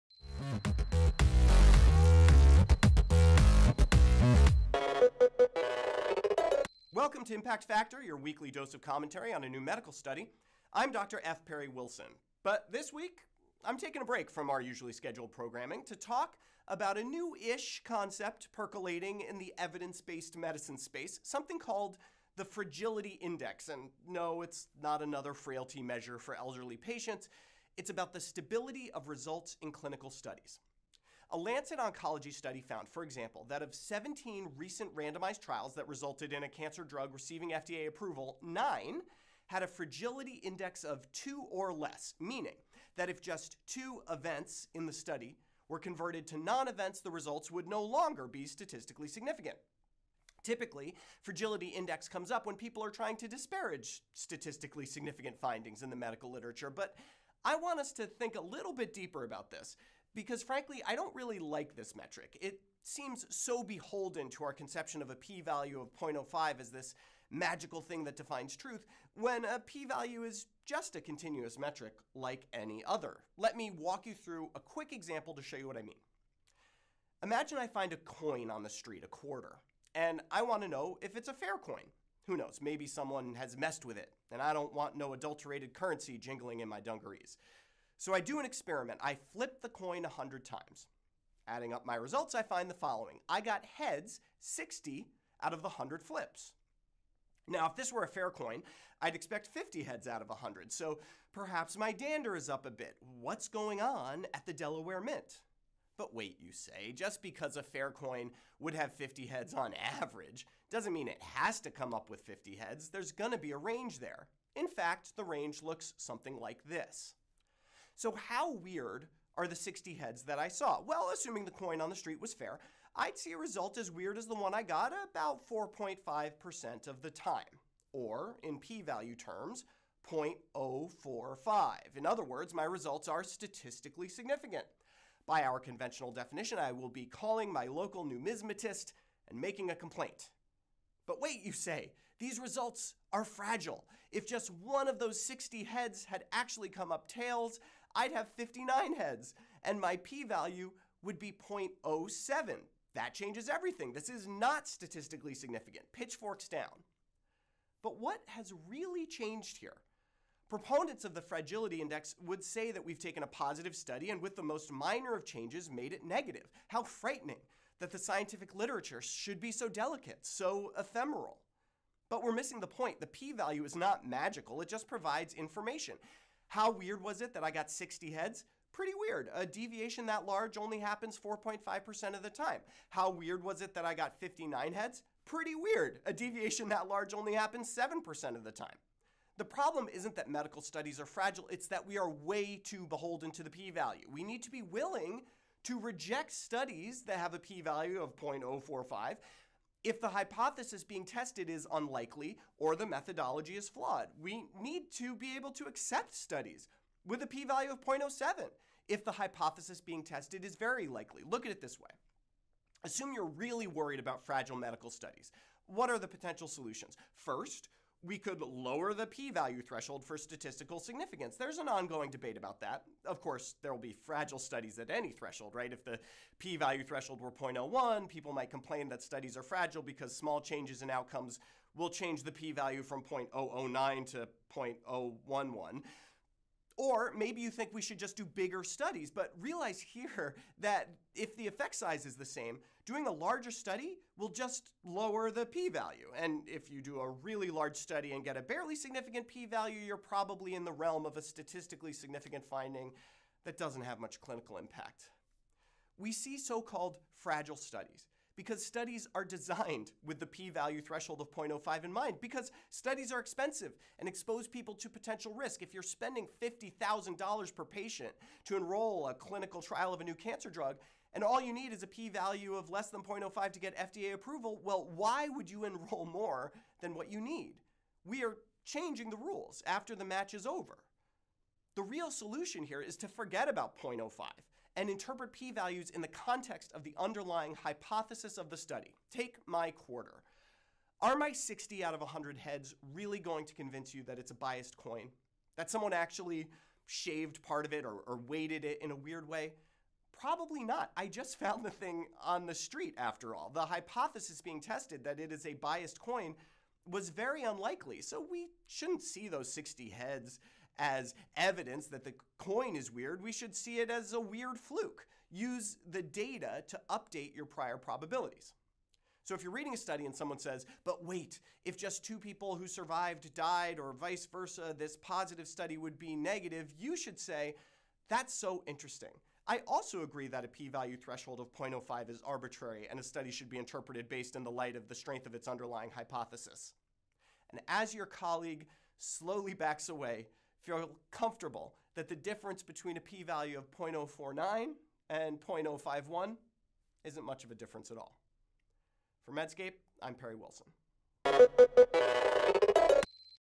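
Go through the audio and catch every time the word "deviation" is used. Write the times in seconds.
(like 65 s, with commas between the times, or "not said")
179 s, 186 s.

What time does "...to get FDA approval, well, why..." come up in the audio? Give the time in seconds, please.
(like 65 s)
273 s.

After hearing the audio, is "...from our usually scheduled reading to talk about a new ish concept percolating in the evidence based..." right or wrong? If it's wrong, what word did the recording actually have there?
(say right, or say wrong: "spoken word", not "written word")
wrong: "programming", not "reading".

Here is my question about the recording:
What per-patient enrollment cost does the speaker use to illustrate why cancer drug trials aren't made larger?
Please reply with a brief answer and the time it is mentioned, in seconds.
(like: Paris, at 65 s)
$50,000, at 266 s.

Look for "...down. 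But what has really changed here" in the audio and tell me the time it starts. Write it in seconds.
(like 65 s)
156 s.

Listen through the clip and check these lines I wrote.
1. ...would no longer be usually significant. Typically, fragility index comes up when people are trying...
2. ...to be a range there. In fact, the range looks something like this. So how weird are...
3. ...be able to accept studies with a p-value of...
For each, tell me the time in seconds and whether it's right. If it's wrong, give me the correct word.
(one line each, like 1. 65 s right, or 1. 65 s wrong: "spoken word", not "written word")
1. 47 s wrong: "statistically", not "usually"
2. 113 s right
3. 205 s right.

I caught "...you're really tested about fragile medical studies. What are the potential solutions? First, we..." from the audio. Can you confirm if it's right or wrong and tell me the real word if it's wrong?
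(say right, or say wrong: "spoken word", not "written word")
wrong: "worried", not "tested".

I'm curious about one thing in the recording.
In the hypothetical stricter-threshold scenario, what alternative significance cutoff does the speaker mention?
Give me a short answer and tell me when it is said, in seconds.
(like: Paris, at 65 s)
0.01, at 227 s.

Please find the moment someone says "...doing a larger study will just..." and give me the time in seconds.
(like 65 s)
242 s.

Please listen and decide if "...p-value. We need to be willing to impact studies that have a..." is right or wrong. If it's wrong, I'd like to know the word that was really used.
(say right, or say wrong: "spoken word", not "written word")
wrong: "reject", not "impact".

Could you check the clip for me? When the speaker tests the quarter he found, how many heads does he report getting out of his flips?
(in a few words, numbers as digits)
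60.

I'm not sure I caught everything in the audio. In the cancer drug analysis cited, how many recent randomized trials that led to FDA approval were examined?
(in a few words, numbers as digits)
17.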